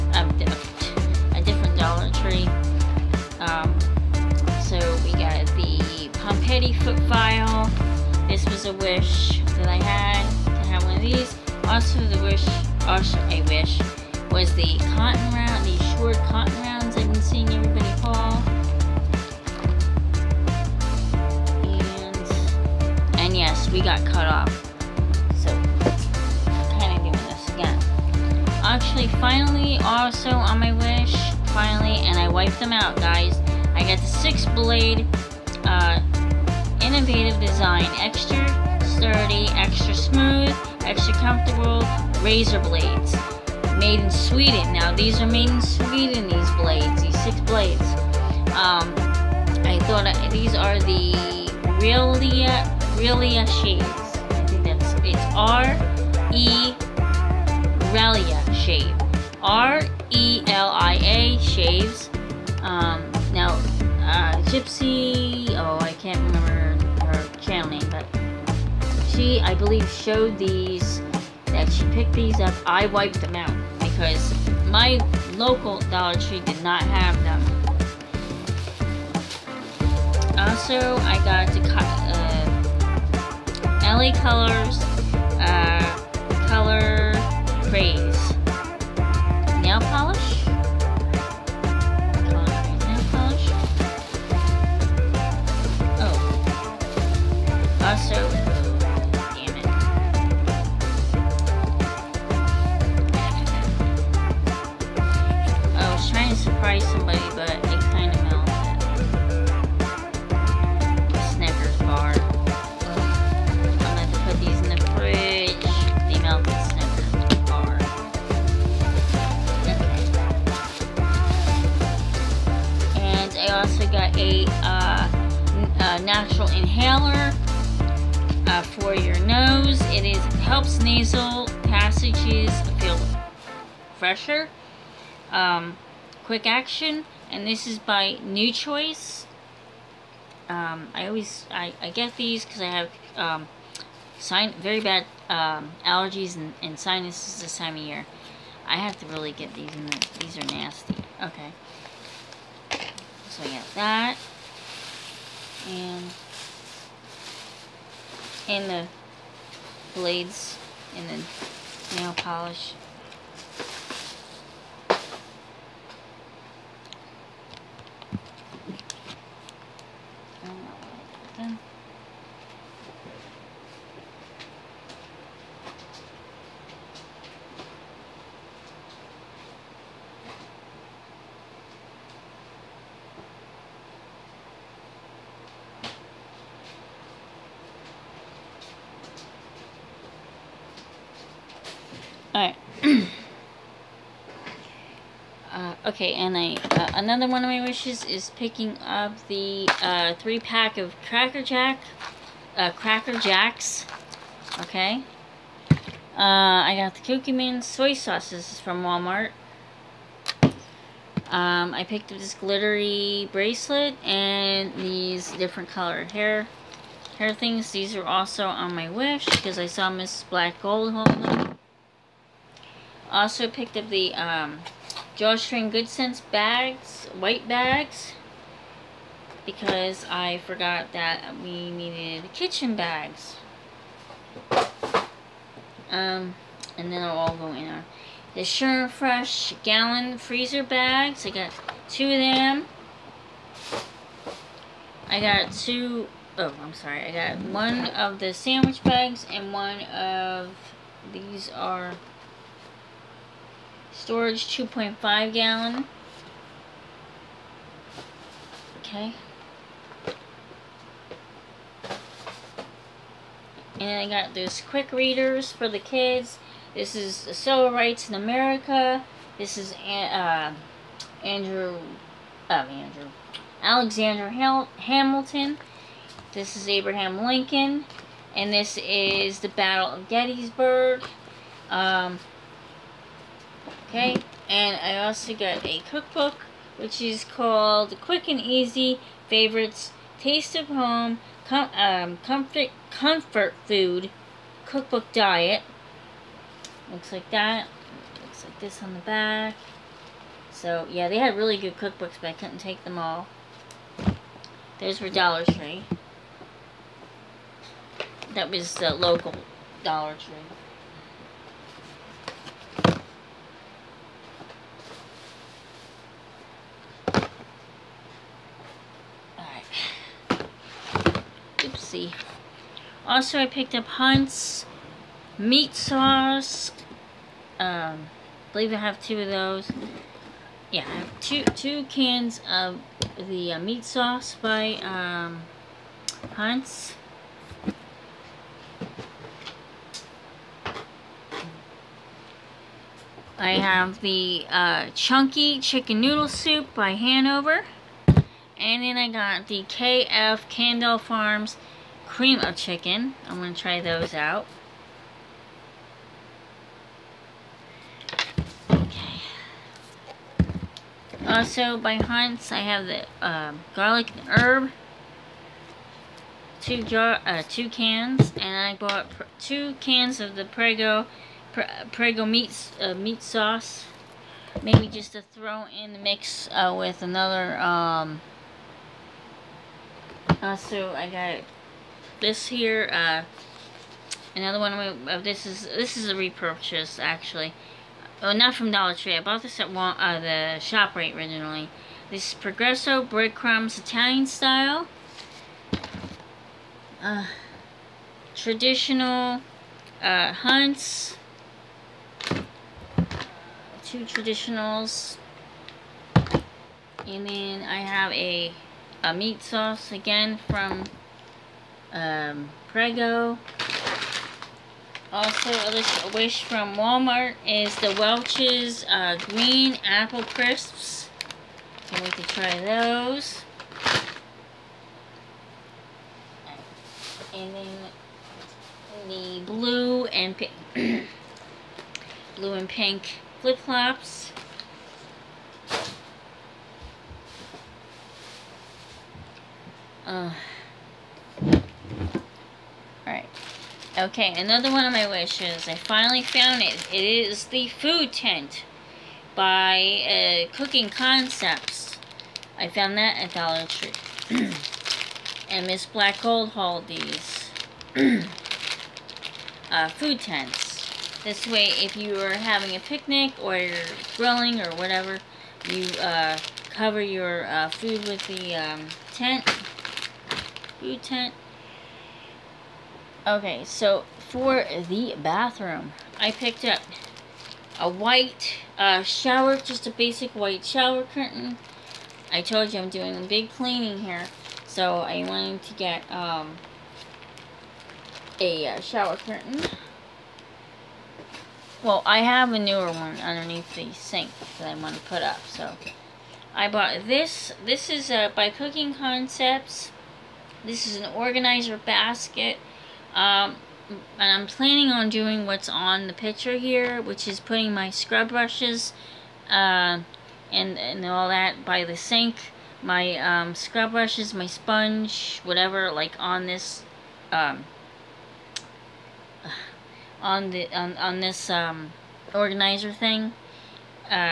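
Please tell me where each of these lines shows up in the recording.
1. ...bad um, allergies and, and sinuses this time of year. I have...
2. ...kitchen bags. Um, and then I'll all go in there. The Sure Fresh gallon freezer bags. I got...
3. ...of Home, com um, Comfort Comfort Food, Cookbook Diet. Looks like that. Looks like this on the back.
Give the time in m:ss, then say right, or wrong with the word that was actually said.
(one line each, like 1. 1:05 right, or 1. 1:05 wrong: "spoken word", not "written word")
1. 2:24 right
2. 3:52 right
3. 4:50 right.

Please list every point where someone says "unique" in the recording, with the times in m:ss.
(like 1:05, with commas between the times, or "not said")
not said.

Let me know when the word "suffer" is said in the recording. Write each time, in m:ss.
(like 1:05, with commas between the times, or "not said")
not said.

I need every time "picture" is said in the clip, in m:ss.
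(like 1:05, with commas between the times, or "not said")
8:26.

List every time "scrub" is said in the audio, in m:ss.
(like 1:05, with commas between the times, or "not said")
8:27, 8:33.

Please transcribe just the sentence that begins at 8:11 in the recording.
Well, I have a newer one underneath the sink that I want to put up, so I bought this.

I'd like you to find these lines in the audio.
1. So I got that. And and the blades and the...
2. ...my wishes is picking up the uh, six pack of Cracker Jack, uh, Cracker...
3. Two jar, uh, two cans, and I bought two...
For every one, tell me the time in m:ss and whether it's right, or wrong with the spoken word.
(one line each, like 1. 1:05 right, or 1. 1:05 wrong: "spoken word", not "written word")
1. 2:33 right
2. 3:17 wrong: "three", not "six"
3. 6:06 right.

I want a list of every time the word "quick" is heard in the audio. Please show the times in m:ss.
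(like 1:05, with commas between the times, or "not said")
2:16, 4:24, 4:48.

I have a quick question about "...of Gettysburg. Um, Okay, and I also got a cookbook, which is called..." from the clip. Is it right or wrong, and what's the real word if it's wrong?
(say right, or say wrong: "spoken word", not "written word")
right.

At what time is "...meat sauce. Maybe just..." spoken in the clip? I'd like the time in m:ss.
6:12.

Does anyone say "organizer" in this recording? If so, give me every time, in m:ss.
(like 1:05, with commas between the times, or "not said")
8:21, 8:42.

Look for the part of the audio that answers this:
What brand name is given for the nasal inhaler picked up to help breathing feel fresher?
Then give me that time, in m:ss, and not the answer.
2:18.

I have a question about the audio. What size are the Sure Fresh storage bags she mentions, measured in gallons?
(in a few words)
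2.5 gallon.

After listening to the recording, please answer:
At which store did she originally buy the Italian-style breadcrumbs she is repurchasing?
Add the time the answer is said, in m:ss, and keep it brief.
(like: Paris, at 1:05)
ShopRite, at 6:30.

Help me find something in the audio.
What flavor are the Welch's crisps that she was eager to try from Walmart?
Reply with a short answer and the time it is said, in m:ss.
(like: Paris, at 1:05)
Green Apple, at 6:59.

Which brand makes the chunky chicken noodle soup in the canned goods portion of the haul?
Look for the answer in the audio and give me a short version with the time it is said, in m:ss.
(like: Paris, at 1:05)
Hanover, at 5:46.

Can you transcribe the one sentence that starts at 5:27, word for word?
Um, I believe I have two of those.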